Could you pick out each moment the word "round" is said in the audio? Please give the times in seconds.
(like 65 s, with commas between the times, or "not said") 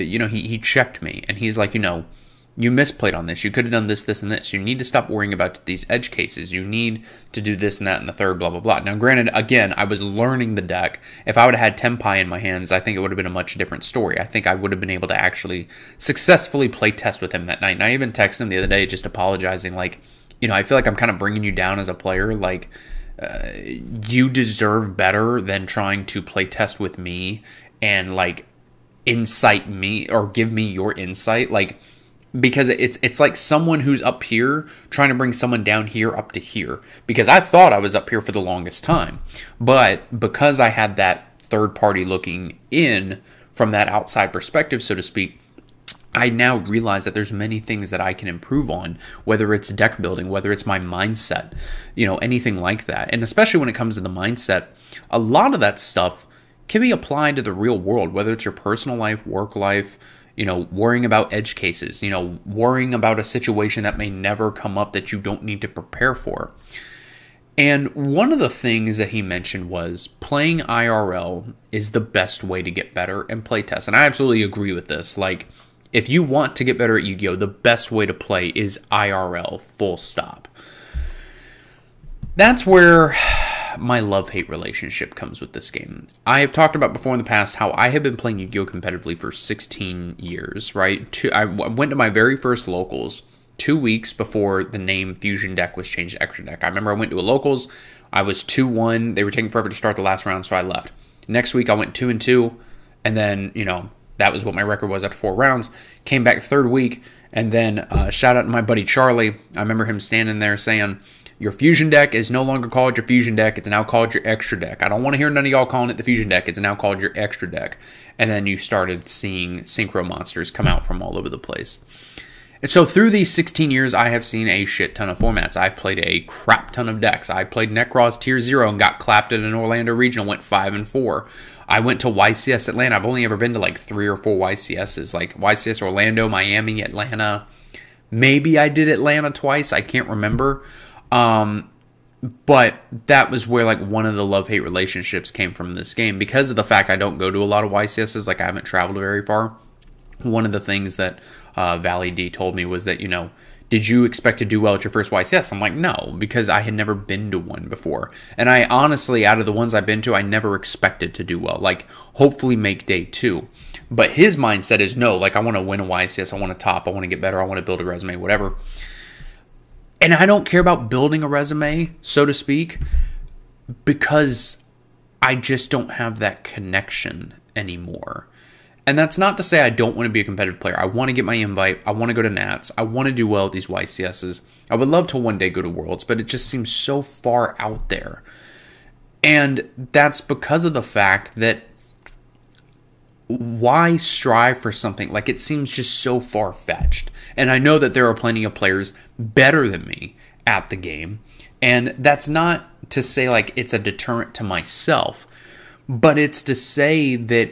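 100 s, 105 s.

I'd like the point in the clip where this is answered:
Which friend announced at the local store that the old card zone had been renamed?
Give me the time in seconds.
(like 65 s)
108 s.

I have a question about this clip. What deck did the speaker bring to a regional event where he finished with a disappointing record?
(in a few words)
Nekroz.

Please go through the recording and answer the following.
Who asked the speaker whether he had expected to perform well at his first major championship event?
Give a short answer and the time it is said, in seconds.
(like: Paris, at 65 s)
Valley D, at 151 s.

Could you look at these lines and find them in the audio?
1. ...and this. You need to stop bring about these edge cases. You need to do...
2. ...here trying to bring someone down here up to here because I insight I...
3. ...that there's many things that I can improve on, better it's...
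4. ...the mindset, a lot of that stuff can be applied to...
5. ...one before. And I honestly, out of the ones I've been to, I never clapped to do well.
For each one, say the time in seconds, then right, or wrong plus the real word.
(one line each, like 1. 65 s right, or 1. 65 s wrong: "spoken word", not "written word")
1. 4 s wrong: "worrying", not "bring"
2. 34 s wrong: "thought", not "insight"
3. 47 s wrong: "whether", not "better"
4. 54 s right
5. 157 s wrong: "expected", not "clapped".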